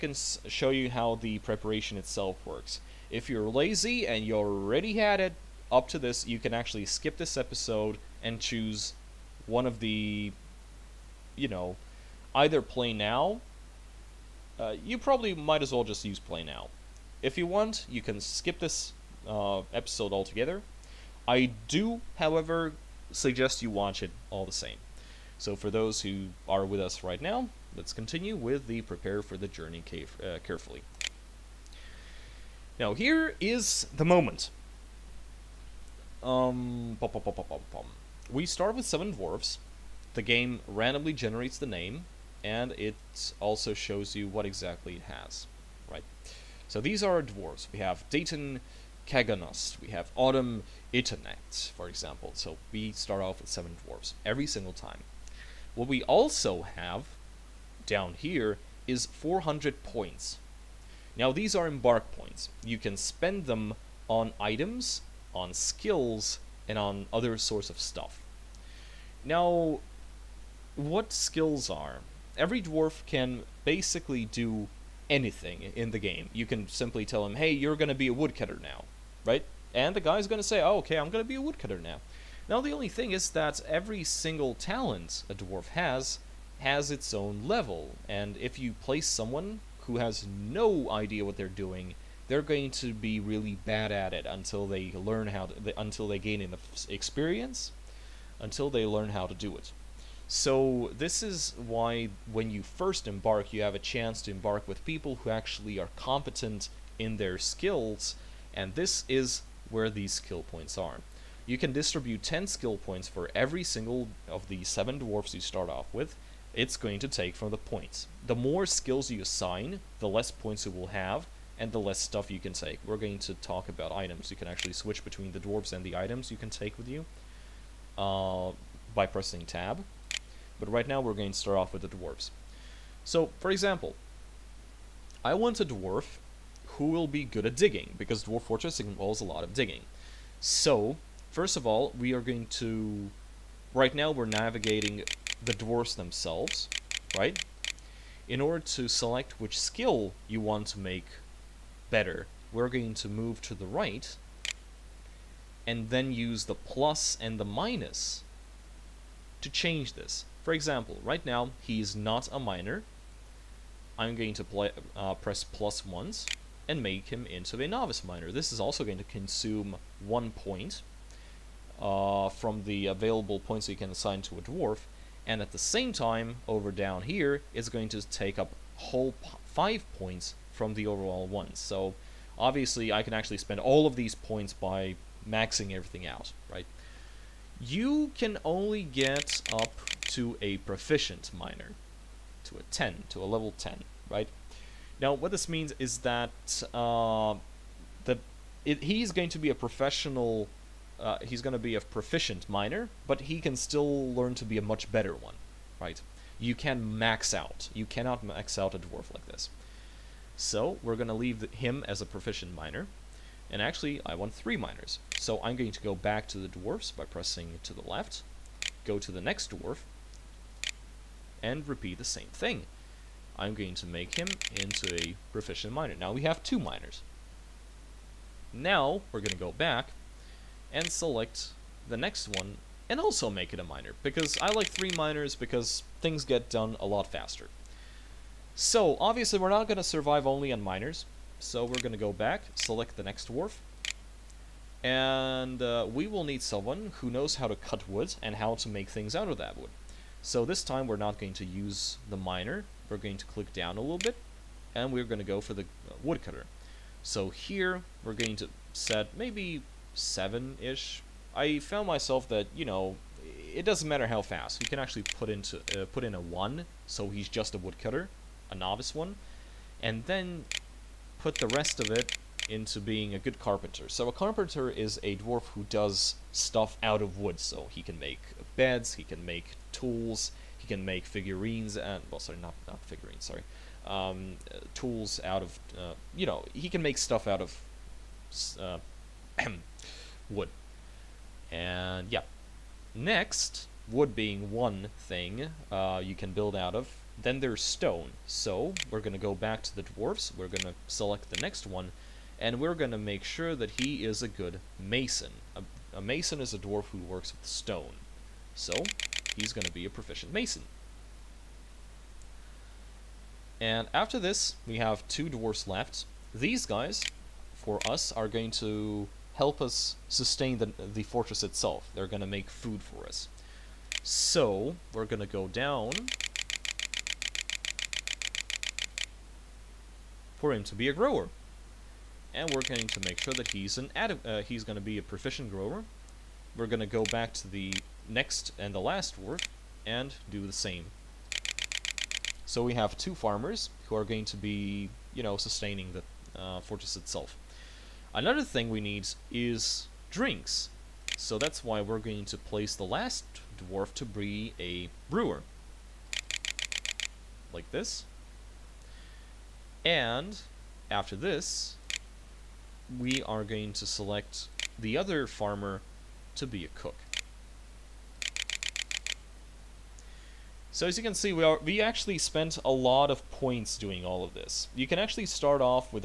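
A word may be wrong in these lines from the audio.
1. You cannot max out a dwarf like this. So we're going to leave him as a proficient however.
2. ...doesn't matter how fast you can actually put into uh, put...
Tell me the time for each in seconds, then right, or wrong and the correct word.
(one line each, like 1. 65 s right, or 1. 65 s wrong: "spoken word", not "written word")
1. 207 s wrong: "miner", not "however"
2. 263 s right.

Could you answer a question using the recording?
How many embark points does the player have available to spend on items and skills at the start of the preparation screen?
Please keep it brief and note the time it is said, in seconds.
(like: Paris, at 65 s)
400, at 59 s.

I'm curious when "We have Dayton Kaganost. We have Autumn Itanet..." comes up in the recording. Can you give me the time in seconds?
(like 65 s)
47 s.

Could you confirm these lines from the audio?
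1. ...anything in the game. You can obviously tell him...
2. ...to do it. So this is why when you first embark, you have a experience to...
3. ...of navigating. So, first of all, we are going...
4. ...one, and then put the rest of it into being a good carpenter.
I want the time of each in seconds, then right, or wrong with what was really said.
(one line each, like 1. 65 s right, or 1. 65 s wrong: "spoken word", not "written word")
1. 75 s wrong: "simply", not "obviously"
2. 99 s wrong: "chance", not "experience"
3. 139 s wrong: "digging", not "navigating"
4. 268 s right.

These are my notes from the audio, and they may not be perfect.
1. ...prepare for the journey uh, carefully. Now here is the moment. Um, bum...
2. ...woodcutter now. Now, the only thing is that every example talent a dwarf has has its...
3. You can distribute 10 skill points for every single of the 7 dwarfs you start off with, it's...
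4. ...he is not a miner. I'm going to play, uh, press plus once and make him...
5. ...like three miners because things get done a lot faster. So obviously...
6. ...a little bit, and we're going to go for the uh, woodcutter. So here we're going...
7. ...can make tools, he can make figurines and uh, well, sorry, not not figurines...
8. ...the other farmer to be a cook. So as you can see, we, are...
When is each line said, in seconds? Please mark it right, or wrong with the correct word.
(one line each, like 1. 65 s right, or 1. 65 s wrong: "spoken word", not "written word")
1. 28 s right
2. 81 s wrong: "single", not "example"
3. 111 s right
4. 161 s right
5. 234 s right
6. 253 s right
7. 279 s right
8. 364 s right.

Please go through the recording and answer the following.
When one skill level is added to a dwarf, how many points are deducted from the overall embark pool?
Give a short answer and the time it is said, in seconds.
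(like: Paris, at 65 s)
5, at 179 s.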